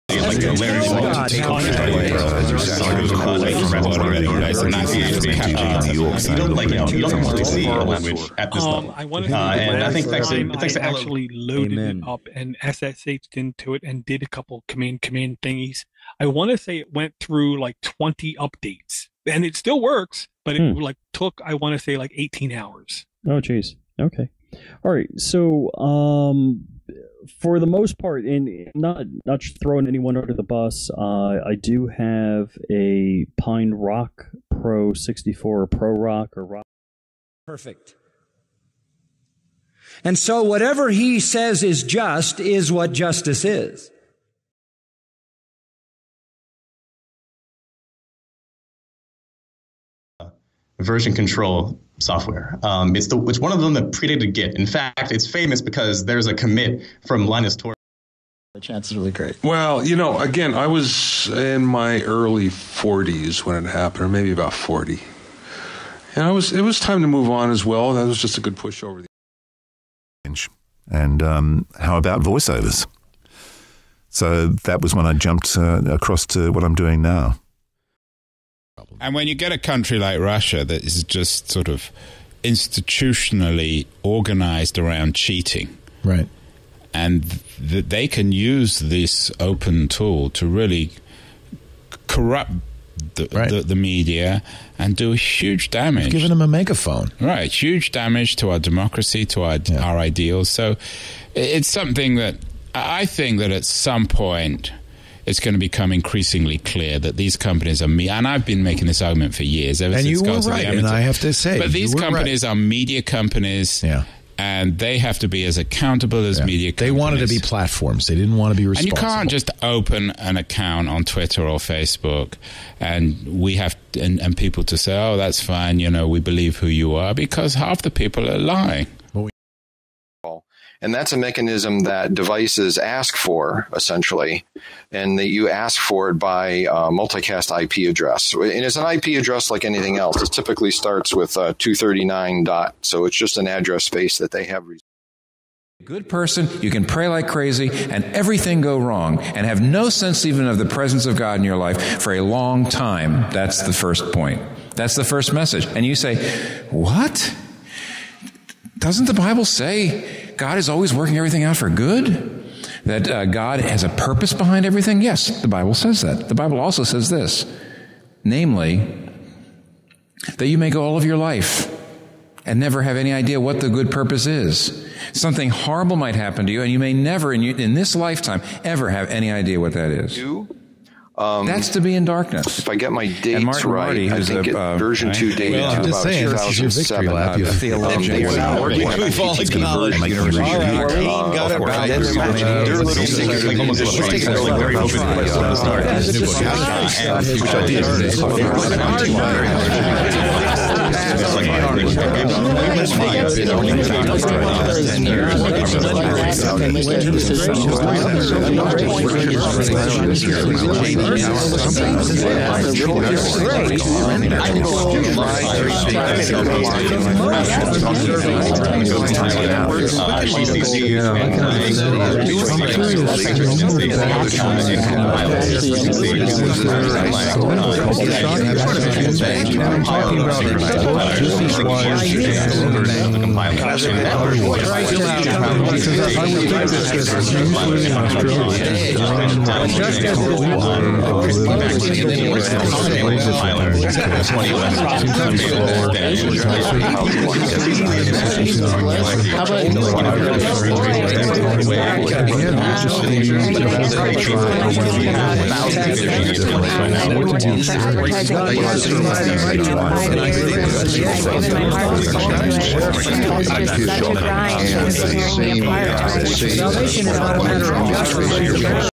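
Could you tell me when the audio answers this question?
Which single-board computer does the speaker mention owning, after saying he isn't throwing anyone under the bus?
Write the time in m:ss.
0:33.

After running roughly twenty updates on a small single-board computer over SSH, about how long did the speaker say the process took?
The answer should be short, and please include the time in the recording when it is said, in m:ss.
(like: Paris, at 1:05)
18 hours, at 0:22.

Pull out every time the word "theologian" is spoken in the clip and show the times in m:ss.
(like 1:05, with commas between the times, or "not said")
3:07.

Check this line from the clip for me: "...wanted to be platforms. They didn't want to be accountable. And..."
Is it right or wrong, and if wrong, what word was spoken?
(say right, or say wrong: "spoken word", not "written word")
wrong: "responsible", not "accountable".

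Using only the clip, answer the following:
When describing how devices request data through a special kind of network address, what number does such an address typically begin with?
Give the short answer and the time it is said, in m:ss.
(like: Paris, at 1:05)
239, at 2:21.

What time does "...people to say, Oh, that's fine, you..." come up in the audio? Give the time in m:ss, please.
2:04.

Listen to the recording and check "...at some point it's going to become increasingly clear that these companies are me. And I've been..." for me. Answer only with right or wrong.
right.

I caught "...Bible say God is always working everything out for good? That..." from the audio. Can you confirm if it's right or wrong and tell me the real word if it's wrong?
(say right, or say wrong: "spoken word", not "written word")
right.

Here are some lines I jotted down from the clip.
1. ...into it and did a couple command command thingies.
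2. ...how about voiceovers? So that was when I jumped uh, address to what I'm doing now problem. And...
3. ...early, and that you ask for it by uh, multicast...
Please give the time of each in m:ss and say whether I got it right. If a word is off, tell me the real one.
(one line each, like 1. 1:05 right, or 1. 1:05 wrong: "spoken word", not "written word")
1. 0:13 right
2. 1:11 wrong: "across", not "address"
3. 2:13 wrong: "essentially", not "early".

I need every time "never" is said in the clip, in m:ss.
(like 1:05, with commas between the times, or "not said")
2:52, 2:56.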